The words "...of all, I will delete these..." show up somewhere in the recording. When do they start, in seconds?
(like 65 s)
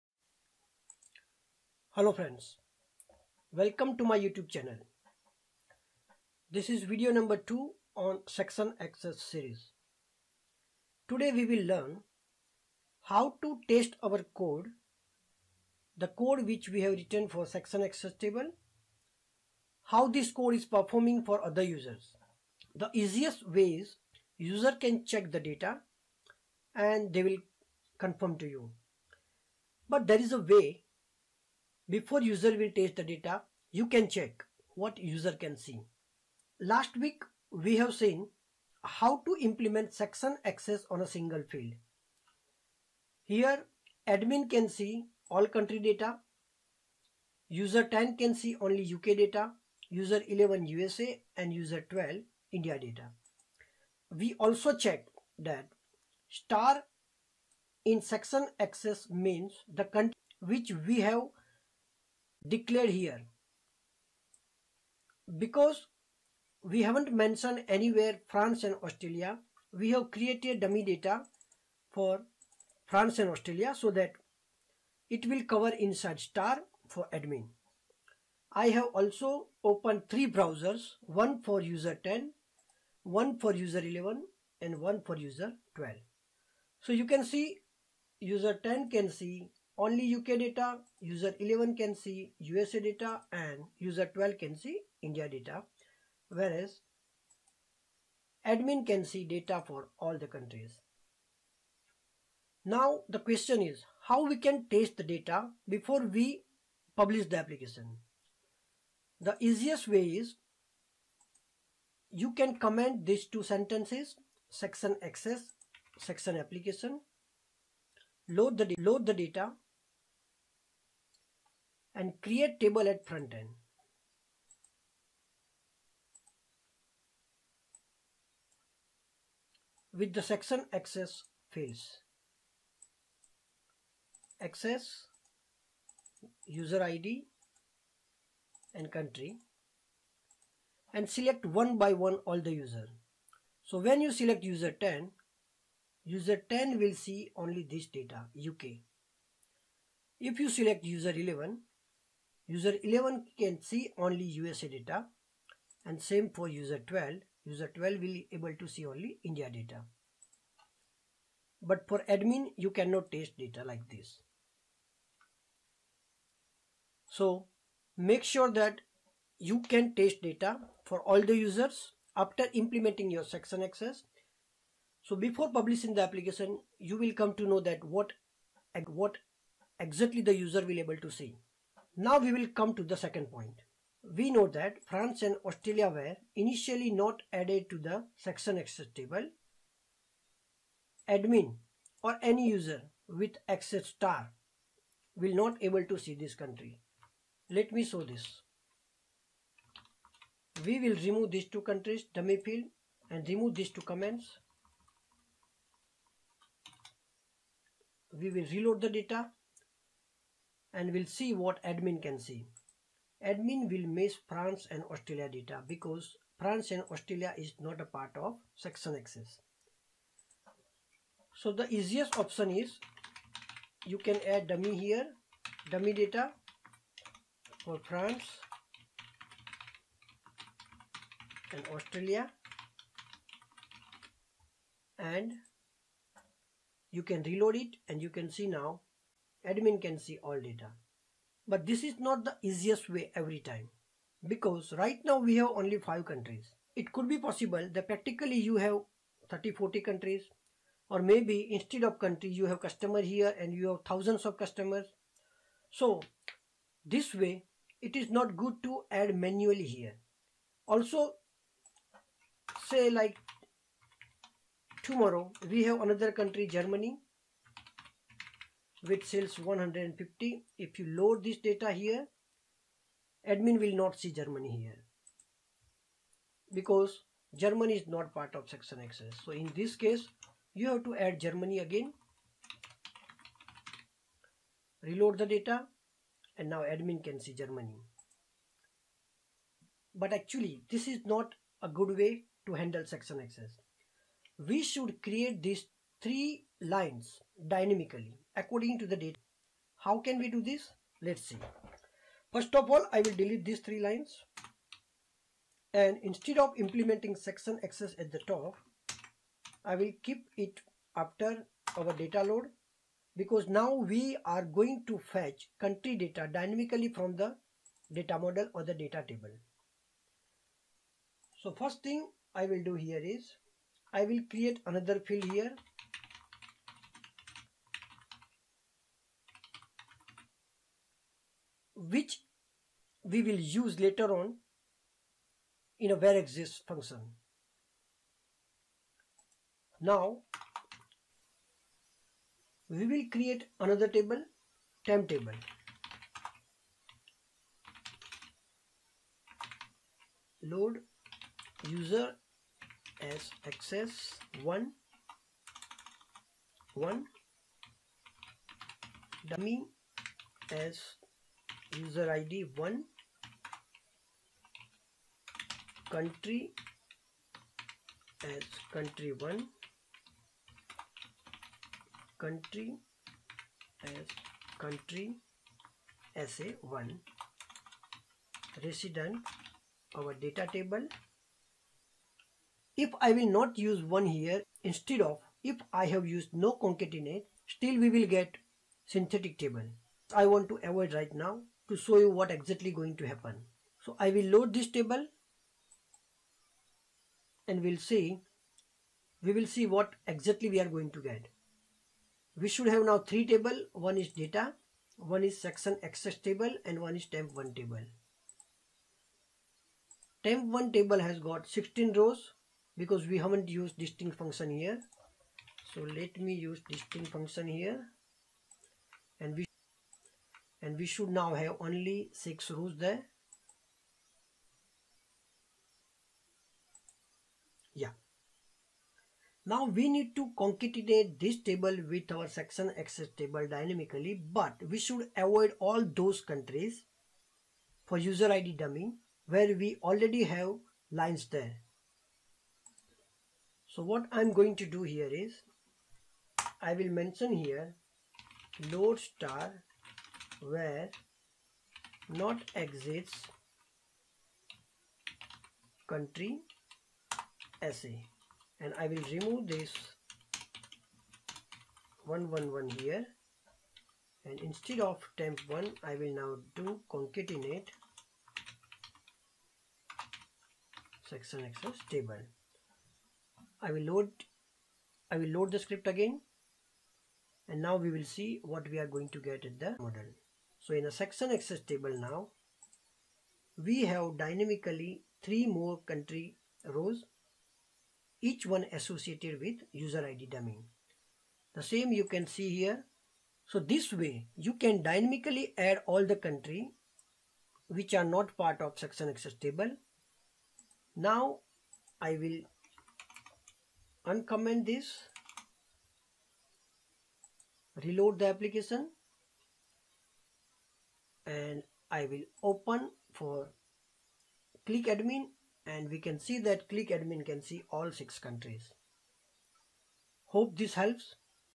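302 s.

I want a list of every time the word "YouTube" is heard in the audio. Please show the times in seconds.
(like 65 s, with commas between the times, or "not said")
4 s.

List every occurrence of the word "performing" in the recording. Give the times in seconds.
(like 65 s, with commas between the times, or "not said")
20 s.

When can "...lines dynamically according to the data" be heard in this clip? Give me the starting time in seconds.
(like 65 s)
296 s.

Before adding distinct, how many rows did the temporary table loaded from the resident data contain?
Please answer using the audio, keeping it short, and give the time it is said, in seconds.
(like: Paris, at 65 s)
16, at 411 s.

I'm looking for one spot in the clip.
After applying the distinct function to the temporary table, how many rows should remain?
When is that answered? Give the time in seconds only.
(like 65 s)
422 s.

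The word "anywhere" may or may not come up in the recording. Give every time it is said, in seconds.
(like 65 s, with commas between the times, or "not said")
67 s.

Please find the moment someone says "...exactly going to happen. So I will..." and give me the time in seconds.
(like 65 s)
392 s.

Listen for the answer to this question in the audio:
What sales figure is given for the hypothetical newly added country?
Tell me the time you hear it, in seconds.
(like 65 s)
269 s.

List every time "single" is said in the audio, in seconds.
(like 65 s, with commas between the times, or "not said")
41 s.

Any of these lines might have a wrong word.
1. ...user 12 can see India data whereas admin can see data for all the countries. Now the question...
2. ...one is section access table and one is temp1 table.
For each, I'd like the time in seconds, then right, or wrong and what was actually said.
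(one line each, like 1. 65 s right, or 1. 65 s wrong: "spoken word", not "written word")
1. 93 s right
2. 404 s right.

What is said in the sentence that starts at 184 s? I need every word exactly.
We know that France and Australia were initially not added to the section access table.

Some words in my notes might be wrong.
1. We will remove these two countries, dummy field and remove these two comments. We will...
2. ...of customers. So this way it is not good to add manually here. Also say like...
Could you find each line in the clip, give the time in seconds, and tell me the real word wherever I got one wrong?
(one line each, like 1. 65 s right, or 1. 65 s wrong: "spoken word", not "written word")
1. 200 s right
2. 254 s right.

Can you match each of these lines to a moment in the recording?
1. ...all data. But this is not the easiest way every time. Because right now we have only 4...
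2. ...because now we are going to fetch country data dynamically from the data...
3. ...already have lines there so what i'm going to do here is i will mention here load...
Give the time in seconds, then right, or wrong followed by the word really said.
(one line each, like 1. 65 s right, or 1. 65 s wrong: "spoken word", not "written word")
1. 240 s wrong: "5", not "4"
2. 313 s right
3. 439 s right.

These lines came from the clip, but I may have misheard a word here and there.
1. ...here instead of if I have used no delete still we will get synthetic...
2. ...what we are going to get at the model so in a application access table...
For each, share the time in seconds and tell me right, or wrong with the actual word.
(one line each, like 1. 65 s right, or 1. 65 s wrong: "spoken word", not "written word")
1. 384 s wrong: "concatenate", not "delete"
2. 478 s wrong: "section", not "application".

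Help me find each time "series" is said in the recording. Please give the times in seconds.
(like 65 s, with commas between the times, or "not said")
9 s.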